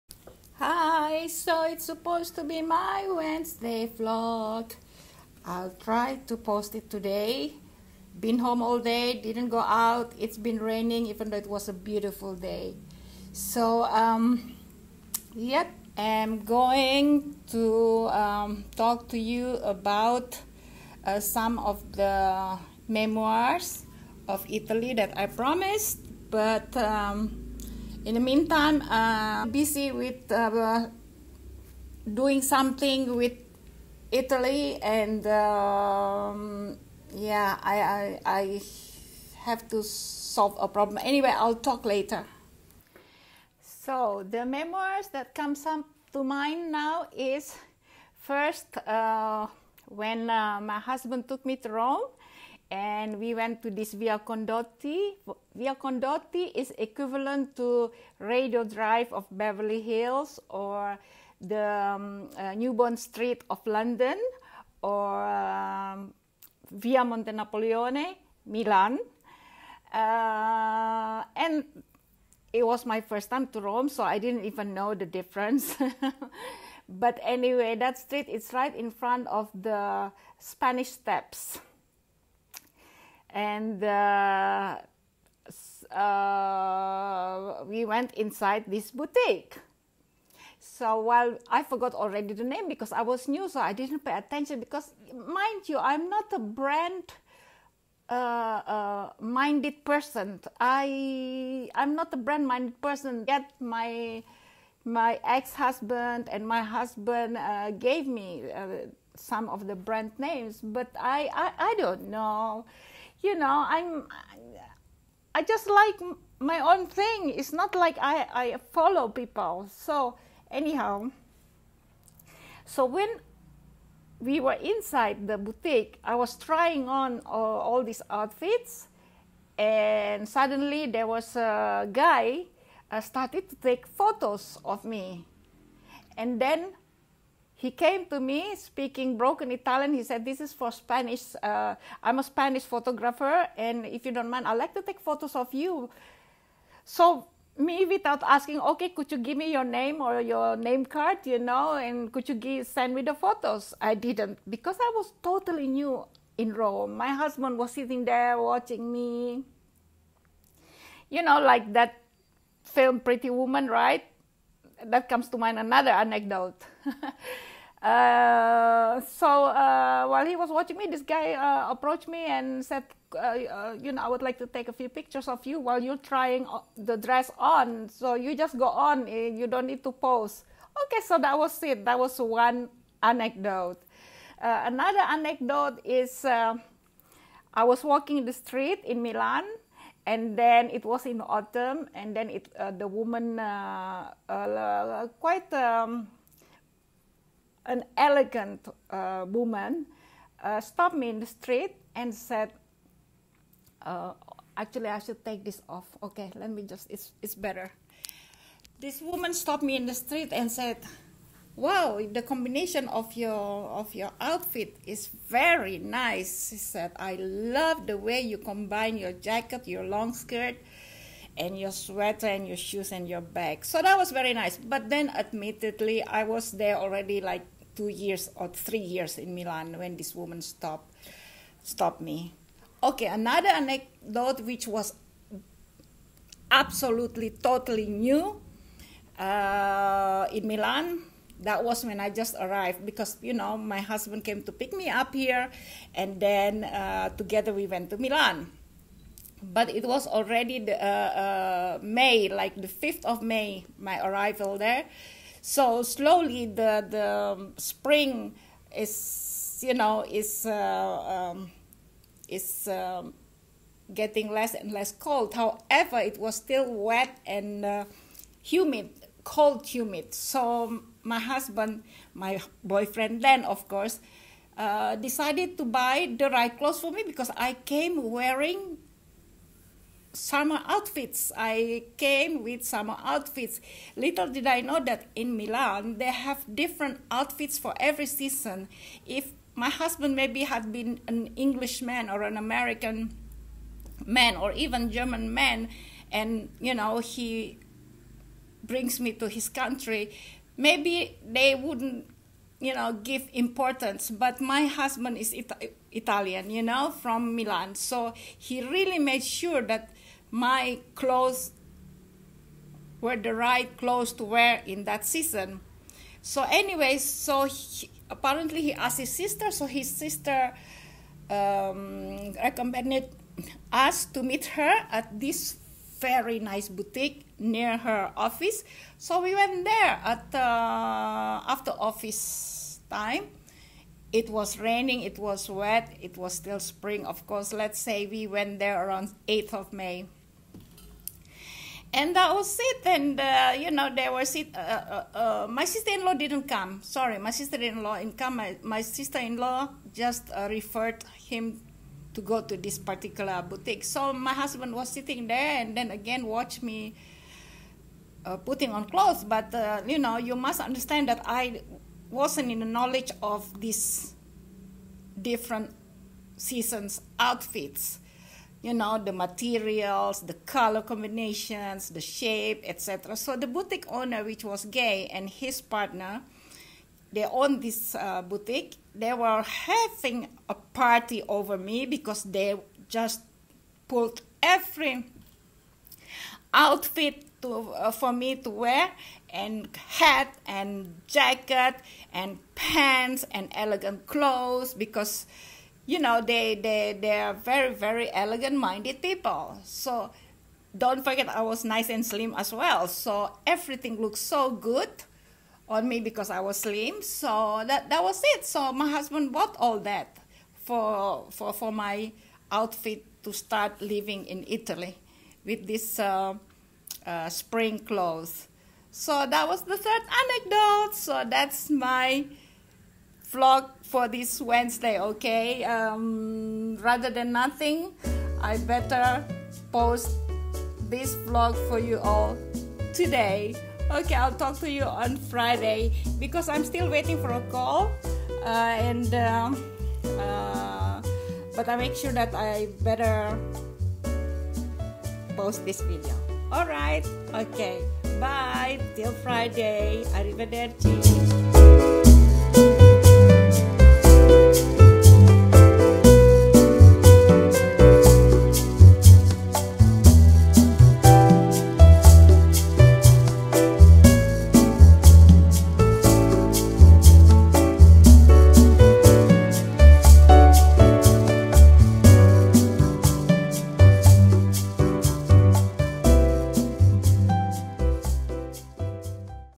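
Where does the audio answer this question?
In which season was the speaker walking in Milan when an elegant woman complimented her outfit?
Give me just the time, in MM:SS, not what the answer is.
03:11.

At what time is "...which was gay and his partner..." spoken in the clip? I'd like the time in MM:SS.
06:14.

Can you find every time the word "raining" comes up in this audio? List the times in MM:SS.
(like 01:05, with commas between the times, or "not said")
00:10, 05:34.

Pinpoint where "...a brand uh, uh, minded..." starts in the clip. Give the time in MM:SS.
01:36.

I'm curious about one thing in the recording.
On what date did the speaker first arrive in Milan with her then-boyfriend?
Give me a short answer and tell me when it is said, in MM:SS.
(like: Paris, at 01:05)
May 5, at 04:12.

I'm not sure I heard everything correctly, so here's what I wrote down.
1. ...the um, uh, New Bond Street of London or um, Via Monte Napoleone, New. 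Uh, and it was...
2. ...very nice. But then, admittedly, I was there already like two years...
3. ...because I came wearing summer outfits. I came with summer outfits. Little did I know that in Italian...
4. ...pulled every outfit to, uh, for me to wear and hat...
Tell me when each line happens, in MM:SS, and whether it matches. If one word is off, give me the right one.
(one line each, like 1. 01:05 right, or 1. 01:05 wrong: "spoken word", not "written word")
1. 01:01 wrong: "Milan", not "New"
2. 03:44 right
3. 04:37 wrong: "Milan", not "Italian"
4. 06:23 right.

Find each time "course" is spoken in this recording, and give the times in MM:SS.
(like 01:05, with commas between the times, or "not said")
04:33, 05:37.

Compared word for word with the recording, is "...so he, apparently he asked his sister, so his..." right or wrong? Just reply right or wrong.
right.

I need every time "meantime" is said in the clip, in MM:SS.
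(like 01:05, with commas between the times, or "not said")
00:28.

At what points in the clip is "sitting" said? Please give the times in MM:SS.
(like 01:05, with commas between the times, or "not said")
02:37, 05:54.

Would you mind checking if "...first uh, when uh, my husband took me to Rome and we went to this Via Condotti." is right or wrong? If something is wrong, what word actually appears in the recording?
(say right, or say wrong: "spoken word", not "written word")
right.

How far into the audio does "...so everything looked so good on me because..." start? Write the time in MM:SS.
06:42.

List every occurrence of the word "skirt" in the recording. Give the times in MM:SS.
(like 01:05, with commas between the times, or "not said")
03:40.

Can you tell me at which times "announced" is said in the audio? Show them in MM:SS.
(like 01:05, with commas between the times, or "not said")
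not said.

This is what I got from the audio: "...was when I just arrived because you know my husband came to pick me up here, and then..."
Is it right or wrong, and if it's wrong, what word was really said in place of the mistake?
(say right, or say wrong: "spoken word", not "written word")
right.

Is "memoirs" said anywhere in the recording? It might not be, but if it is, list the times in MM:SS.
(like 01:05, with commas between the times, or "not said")
00:22, 00:44.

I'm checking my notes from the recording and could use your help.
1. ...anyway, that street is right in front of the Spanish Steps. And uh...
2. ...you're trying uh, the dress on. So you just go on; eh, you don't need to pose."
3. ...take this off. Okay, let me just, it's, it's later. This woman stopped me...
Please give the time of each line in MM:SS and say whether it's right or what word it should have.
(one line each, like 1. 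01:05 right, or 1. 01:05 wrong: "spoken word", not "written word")
1. 01:17 right
2. 02:55 right
3. 03:25 wrong: "better", not "later".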